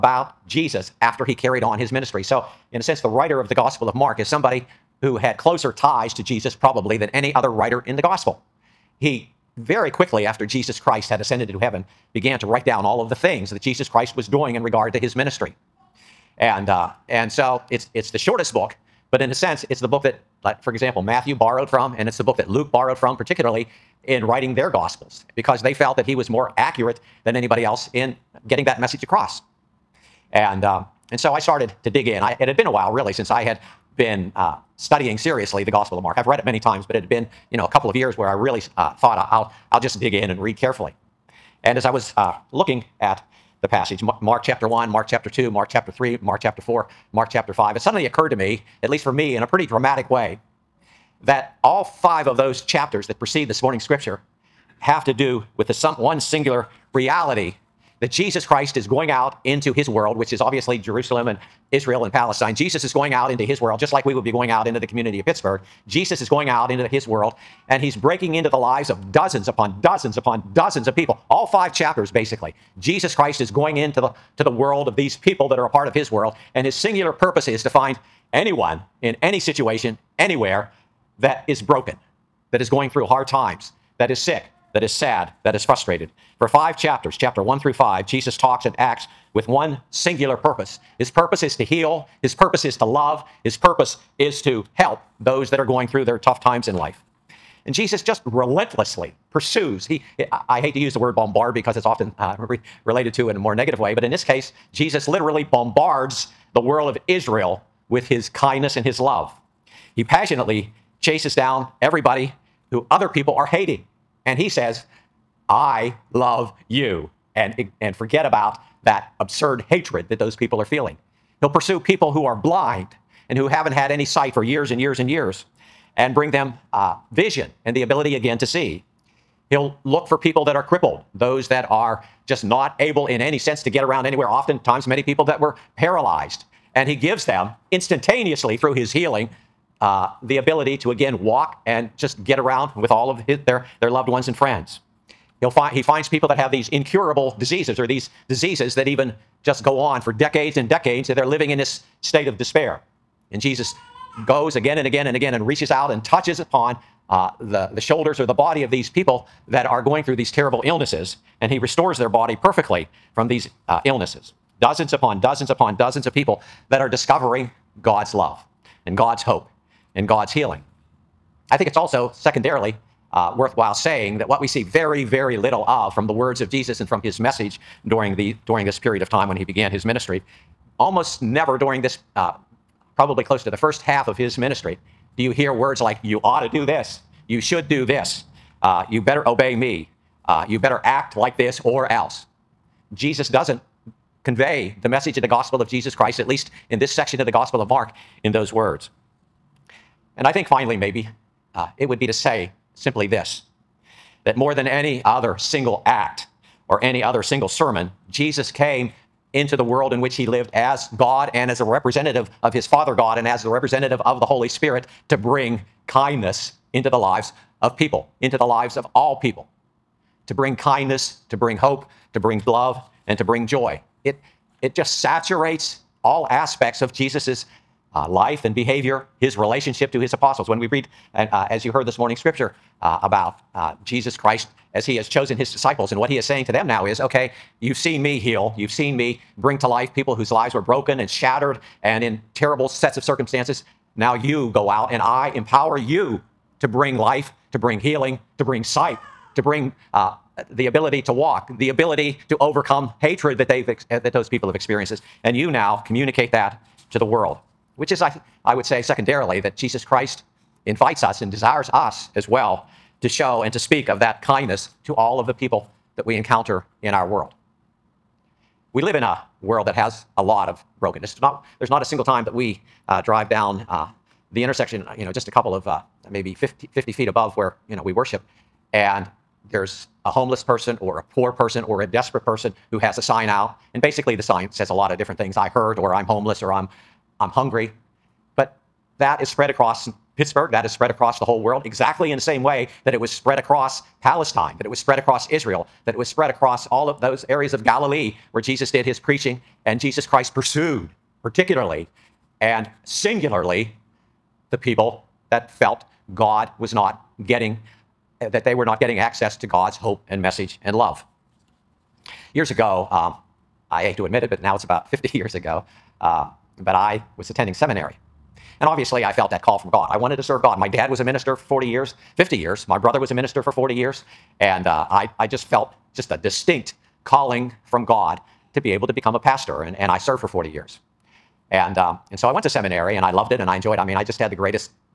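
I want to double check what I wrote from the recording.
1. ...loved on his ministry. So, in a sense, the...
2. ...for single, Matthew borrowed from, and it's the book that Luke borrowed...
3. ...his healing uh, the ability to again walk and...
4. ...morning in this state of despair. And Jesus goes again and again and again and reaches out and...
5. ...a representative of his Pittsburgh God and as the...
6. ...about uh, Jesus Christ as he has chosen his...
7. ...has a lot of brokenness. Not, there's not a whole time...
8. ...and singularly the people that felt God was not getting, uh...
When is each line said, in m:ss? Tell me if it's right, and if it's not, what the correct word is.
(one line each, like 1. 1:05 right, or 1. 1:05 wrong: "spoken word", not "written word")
1. 0:01 wrong: "carried", not "loved"
2. 0:20 wrong: "example", not "single"
3. 2:18 right
4. 2:31 wrong: "living", not "morning"
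5. 3:31 wrong: "Father", not "Pittsburgh"
6. 3:53 right
7. 4:29 wrong: "single", not "whole"
8. 5:02 right.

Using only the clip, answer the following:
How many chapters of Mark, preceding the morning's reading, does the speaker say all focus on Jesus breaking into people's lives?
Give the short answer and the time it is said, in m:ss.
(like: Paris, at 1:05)
5, at 0:51.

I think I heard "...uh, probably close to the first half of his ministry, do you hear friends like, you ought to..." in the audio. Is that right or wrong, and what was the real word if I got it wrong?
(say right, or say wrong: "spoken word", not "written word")
wrong: "words", not "friends".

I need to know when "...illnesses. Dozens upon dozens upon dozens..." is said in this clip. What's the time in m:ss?
2:43.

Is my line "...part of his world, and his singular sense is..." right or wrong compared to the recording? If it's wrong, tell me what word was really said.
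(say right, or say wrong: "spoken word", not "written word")
wrong: "purpose", not "sense".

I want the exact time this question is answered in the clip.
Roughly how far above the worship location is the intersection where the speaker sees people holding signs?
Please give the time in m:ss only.
4:36.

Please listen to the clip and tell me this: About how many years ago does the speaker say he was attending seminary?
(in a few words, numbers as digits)
50 years.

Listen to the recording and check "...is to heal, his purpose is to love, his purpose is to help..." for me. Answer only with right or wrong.
right.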